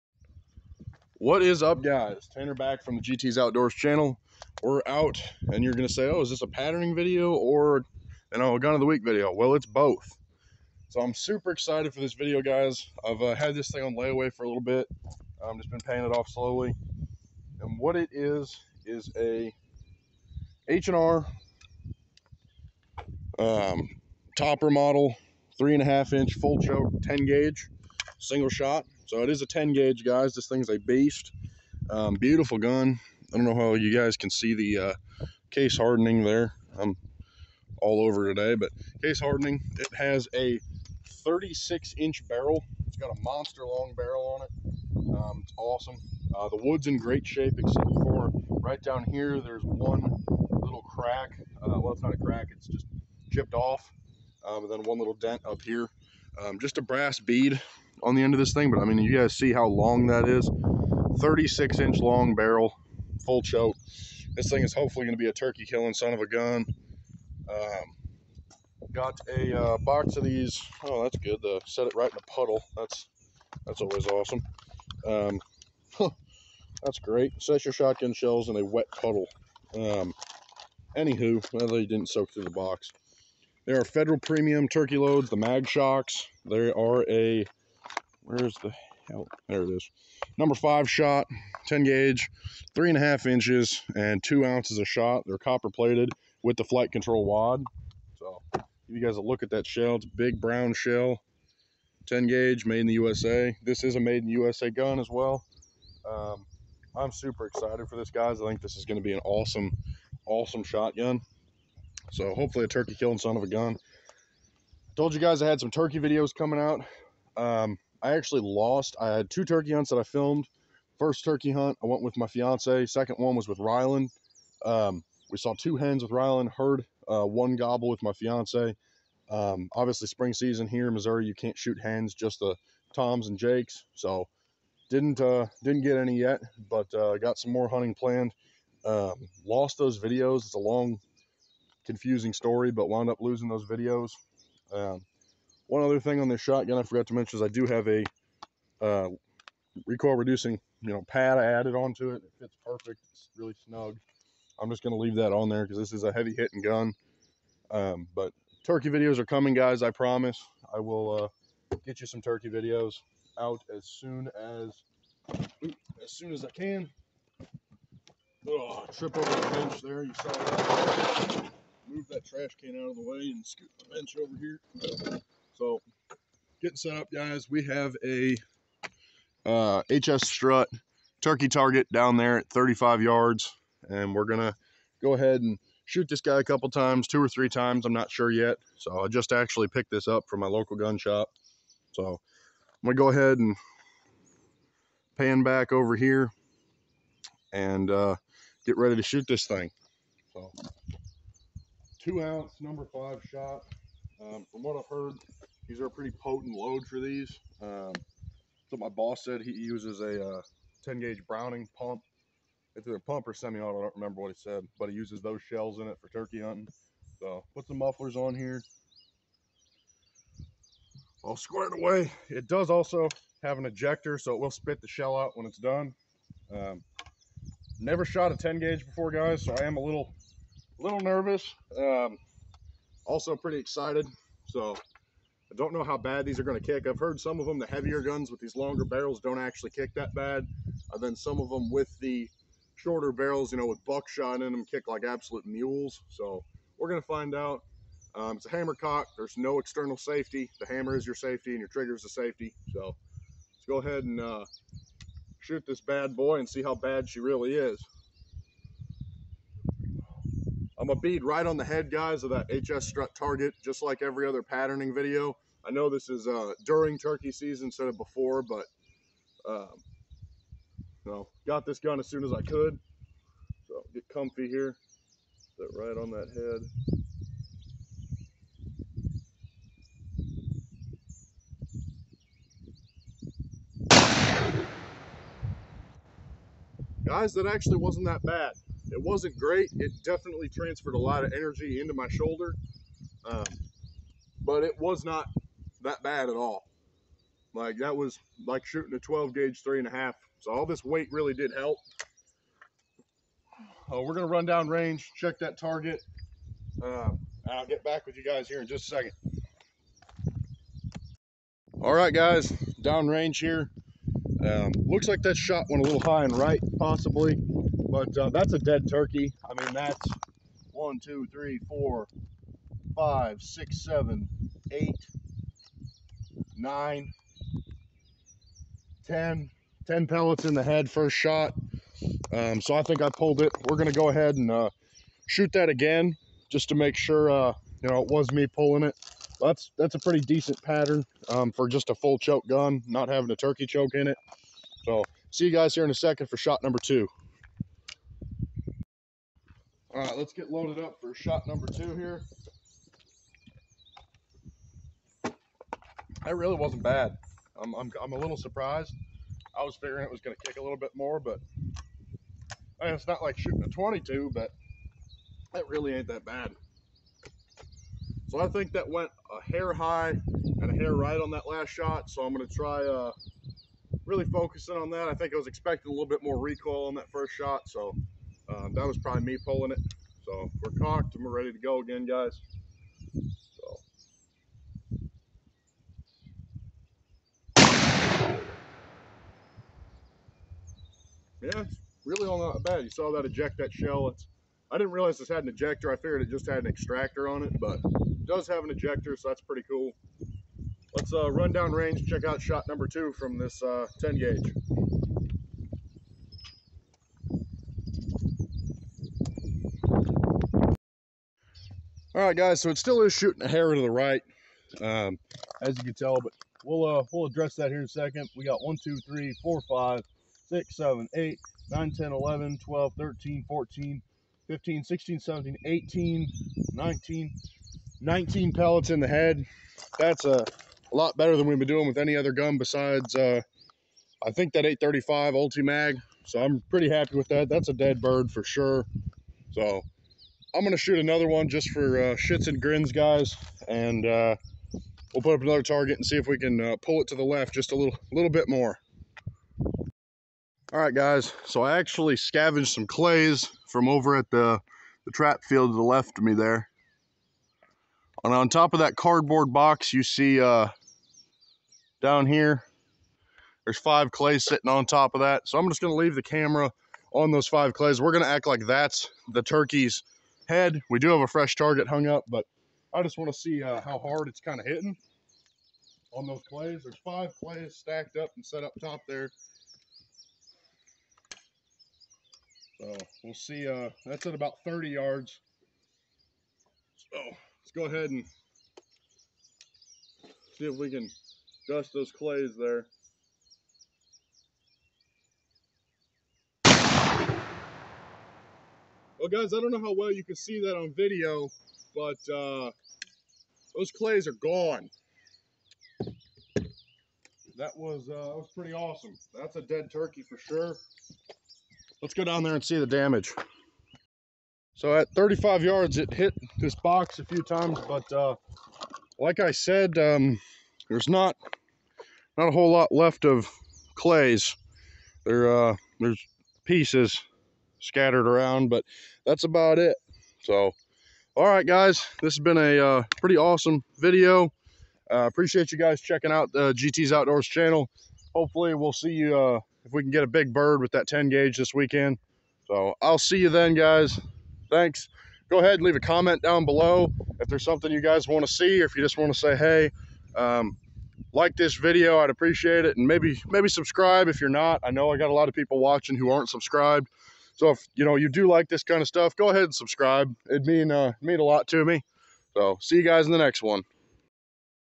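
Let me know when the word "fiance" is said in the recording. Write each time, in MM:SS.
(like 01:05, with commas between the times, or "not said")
02:02, 02:08.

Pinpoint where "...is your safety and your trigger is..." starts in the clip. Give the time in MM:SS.
04:10.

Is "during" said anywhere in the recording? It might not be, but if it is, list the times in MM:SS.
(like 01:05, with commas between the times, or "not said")
04:26.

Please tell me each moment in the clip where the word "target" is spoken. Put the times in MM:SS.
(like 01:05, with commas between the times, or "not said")
03:01, 04:23, 05:05, 07:25, 07:51.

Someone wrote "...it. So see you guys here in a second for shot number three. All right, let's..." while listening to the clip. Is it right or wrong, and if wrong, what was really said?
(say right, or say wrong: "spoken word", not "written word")
wrong: "two", not "three".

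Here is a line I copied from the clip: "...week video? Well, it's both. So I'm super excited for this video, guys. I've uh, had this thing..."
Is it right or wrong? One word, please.
right.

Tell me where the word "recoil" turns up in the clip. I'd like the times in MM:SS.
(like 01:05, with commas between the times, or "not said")
02:29, 06:16.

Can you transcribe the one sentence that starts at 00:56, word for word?
Um, just a brass bead on the end of this thing, but I mean, you guys see how long that is.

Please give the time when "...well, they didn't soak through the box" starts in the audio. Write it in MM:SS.
01:21.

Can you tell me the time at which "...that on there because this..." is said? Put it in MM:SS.
02:35.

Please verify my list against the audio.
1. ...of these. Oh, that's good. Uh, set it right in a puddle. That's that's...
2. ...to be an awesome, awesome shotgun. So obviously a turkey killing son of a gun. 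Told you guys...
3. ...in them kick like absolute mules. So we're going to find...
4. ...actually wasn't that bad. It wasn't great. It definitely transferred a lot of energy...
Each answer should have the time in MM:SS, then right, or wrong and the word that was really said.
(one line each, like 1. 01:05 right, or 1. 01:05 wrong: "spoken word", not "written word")
1. 01:10 right
2. 01:48 wrong: "hopefully", not "obviously"
3. 04:04 right
4. 04:47 right.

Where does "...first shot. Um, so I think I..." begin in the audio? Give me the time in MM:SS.
05:30.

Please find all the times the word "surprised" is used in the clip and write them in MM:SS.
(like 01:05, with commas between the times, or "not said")
05:58.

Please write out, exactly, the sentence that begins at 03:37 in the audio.
So put some mufflers on here.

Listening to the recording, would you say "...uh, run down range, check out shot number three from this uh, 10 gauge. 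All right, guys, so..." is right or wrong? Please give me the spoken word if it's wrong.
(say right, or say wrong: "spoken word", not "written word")
wrong: "two", not "three".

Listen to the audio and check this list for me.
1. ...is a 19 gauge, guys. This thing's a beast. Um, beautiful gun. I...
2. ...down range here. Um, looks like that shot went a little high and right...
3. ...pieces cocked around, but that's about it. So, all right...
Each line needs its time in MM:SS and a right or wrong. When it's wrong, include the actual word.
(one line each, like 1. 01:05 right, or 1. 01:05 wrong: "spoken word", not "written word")
1. 00:29 wrong: "10", not "19"
2. 05:12 right
3. 08:46 wrong: "scattered", not "cocked".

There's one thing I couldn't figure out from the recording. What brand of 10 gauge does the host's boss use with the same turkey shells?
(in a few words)
Browning.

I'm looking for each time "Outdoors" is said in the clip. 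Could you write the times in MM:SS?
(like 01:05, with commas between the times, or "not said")
00:03, 08:57.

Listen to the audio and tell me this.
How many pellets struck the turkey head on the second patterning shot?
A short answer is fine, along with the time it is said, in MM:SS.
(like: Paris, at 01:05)
19, at 07:08.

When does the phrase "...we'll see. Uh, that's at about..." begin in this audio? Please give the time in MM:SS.
08:03.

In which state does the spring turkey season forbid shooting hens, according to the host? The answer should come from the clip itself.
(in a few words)
Missouri.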